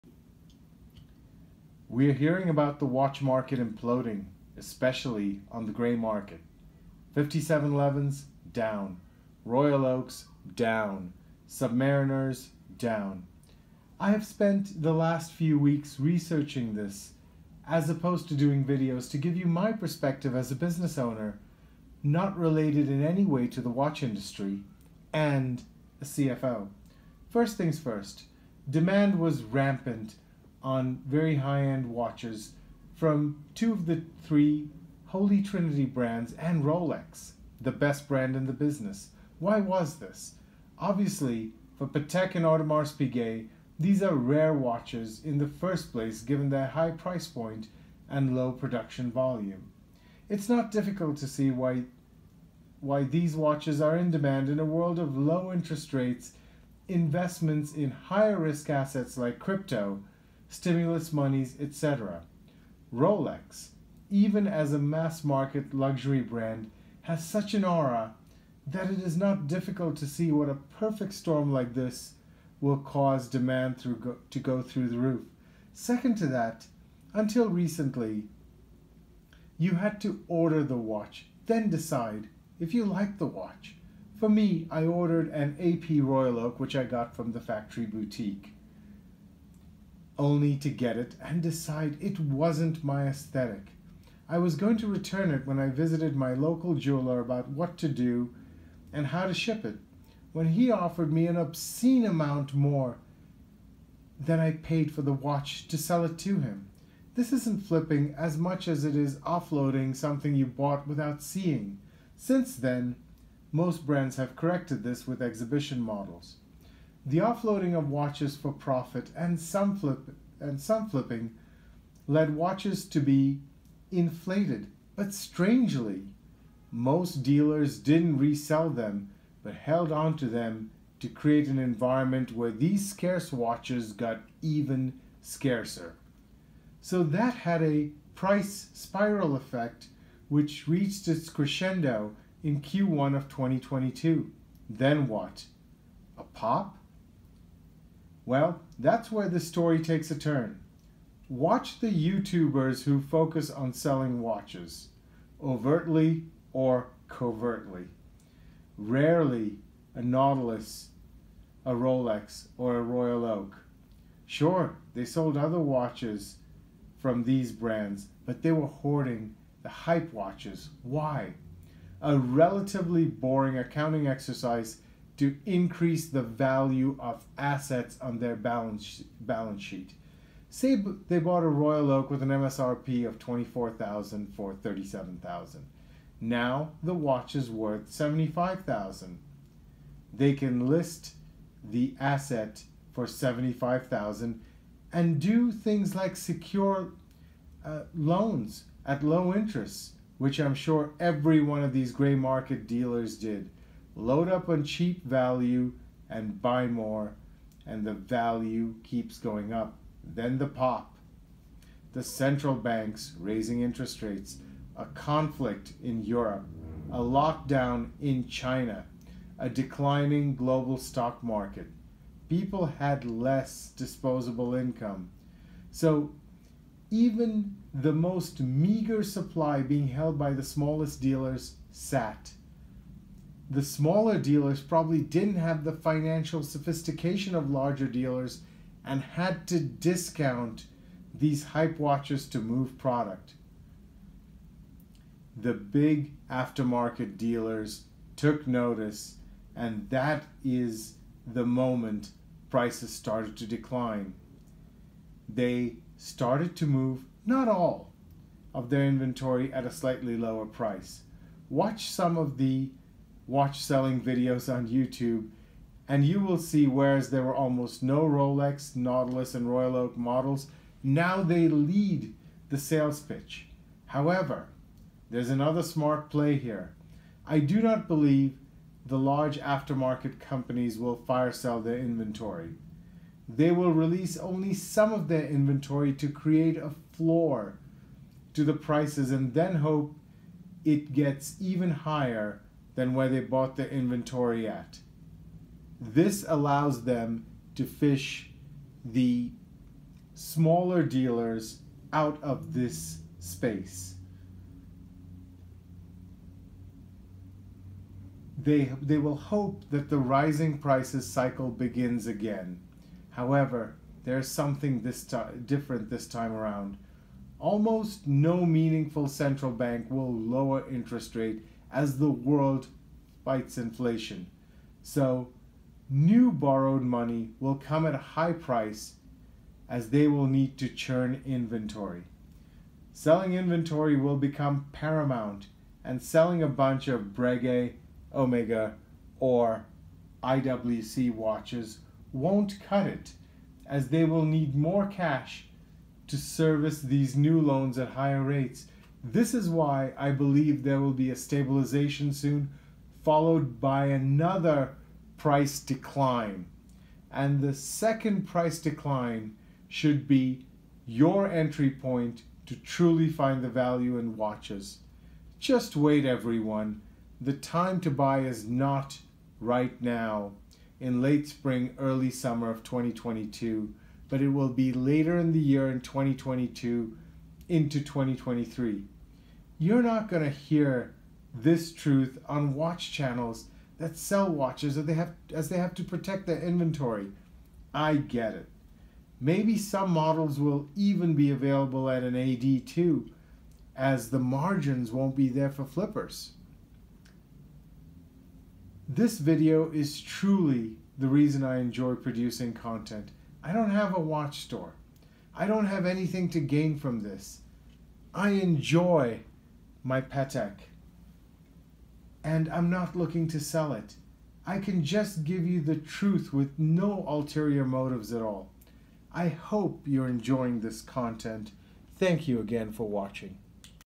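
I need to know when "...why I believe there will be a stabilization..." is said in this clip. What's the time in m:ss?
5:49.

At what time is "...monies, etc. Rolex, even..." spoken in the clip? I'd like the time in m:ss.
1:01.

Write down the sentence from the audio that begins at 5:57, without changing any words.
And the second price decline should be your entry point to truly find the value in watches.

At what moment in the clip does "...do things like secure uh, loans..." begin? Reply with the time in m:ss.
3:15.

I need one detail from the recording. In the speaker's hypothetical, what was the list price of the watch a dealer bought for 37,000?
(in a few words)
24,000.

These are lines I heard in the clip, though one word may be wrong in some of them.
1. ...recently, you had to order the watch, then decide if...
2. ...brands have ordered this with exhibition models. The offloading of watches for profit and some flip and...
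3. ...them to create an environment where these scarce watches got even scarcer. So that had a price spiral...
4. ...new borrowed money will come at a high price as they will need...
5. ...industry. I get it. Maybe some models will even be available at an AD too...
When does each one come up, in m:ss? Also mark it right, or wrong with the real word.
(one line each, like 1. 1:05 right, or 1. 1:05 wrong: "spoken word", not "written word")
1. 1:17 right
2. 1:53 wrong: "corrected", not "ordered"
3. 2:10 right
4. 5:25 right
5. 6:26 wrong: "inventory", not "industry".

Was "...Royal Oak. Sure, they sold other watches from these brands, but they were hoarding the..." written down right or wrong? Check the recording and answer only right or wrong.
right.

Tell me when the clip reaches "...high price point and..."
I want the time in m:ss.
0:46.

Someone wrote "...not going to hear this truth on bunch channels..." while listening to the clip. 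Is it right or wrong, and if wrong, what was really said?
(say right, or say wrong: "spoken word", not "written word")
wrong: "watch", not "bunch".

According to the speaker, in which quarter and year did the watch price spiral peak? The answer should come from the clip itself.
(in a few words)
Q1 of 2022.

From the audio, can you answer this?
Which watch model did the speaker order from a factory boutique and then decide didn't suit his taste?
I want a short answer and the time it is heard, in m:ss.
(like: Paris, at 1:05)
AP Royal Oak, at 1:25.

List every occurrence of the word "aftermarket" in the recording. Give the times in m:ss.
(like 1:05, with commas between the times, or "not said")
4:06, 4:39.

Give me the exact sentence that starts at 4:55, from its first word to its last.
This allows them to fish the smaller dealers out of this space.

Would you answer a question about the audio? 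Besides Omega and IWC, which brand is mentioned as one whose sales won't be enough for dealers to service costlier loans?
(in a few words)
Breguet.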